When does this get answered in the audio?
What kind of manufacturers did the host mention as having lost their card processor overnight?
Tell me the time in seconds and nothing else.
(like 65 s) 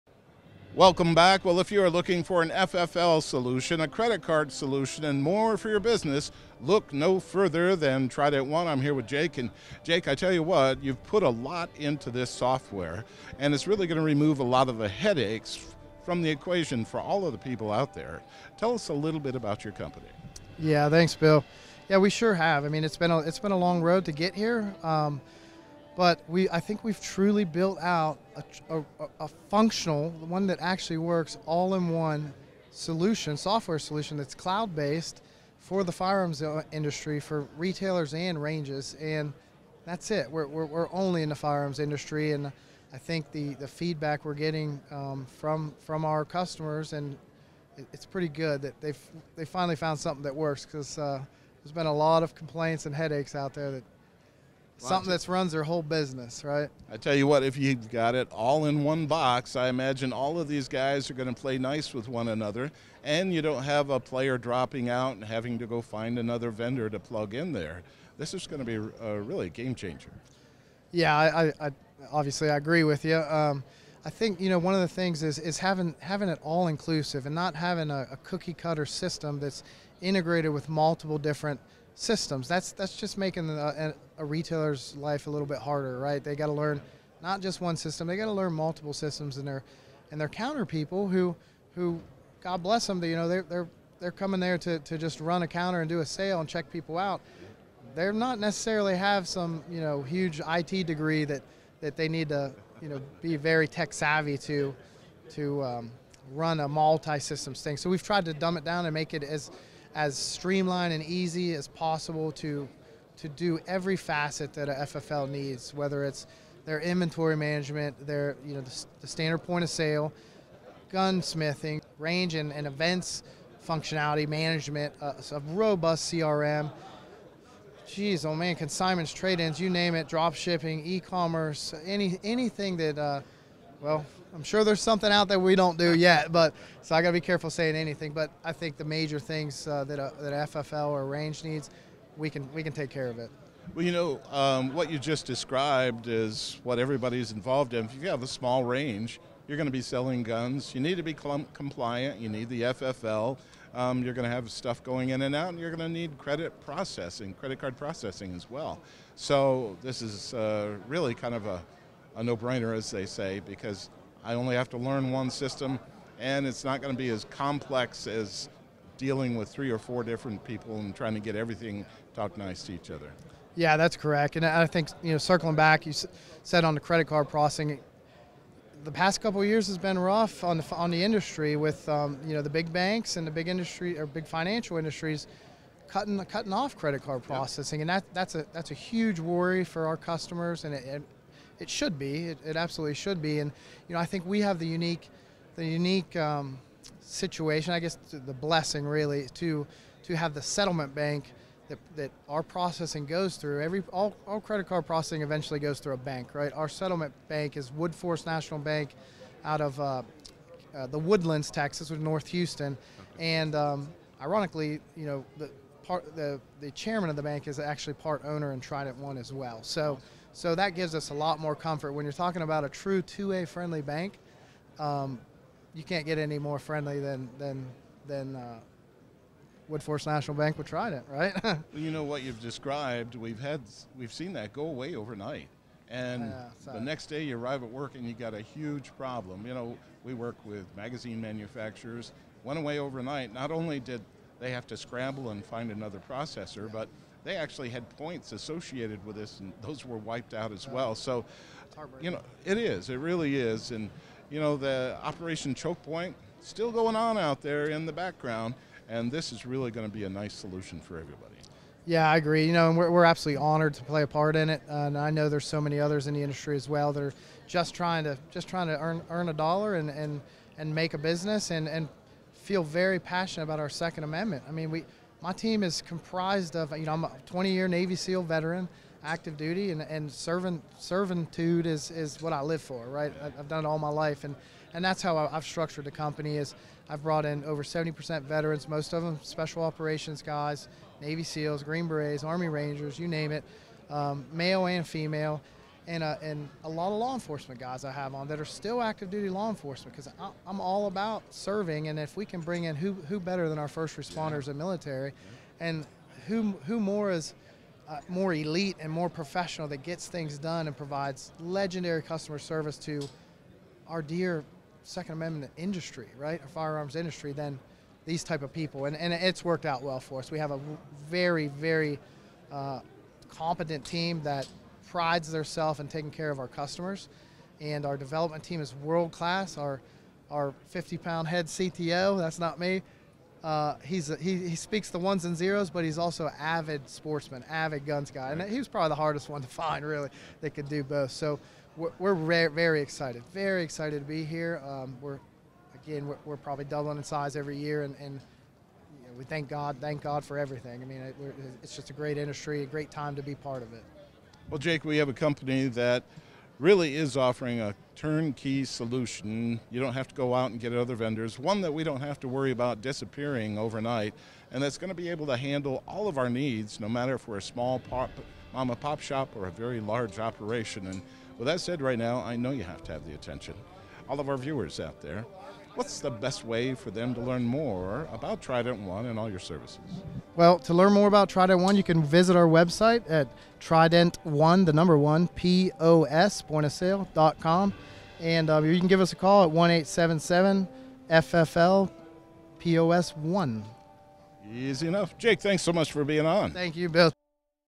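240 s.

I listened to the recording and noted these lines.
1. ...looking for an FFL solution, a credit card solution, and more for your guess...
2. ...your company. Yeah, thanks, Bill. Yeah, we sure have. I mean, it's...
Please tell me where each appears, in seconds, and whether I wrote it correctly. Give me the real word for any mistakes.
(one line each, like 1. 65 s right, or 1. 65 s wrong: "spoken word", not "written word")
1. 1 s wrong: "business", not "guess"
2. 19 s right.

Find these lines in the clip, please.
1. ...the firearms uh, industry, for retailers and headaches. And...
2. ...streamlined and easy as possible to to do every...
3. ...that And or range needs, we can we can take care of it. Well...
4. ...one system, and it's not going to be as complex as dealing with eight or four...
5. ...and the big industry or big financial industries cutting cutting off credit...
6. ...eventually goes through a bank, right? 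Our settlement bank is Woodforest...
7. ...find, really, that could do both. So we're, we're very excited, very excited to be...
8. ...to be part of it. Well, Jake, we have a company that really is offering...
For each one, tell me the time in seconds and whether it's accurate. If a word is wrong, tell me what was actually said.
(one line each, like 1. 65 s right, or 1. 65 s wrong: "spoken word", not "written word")
1. 35 s wrong: "ranges", not "headaches"
2. 110 s right
3. 140 s wrong: "FFL", not "And"
4. 165 s wrong: "three", not "eight"
5. 183 s right
6. 205 s right
7. 339 s right
8. 353 s right.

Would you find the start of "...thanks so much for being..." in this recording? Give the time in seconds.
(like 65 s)
395 s.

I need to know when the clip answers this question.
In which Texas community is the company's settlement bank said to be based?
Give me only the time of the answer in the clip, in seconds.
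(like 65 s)
210 s.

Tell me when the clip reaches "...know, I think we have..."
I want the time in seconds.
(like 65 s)
193 s.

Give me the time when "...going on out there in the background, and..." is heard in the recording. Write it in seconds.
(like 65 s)
256 s.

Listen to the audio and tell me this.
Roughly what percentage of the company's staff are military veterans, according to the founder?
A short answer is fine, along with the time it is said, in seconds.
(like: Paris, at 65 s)
Over 70%, at 287 s.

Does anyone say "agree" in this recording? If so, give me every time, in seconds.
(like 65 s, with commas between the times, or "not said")
72 s, 262 s.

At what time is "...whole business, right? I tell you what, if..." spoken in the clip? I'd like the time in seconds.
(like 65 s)
55 s.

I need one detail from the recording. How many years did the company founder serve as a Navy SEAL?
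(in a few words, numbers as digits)
20.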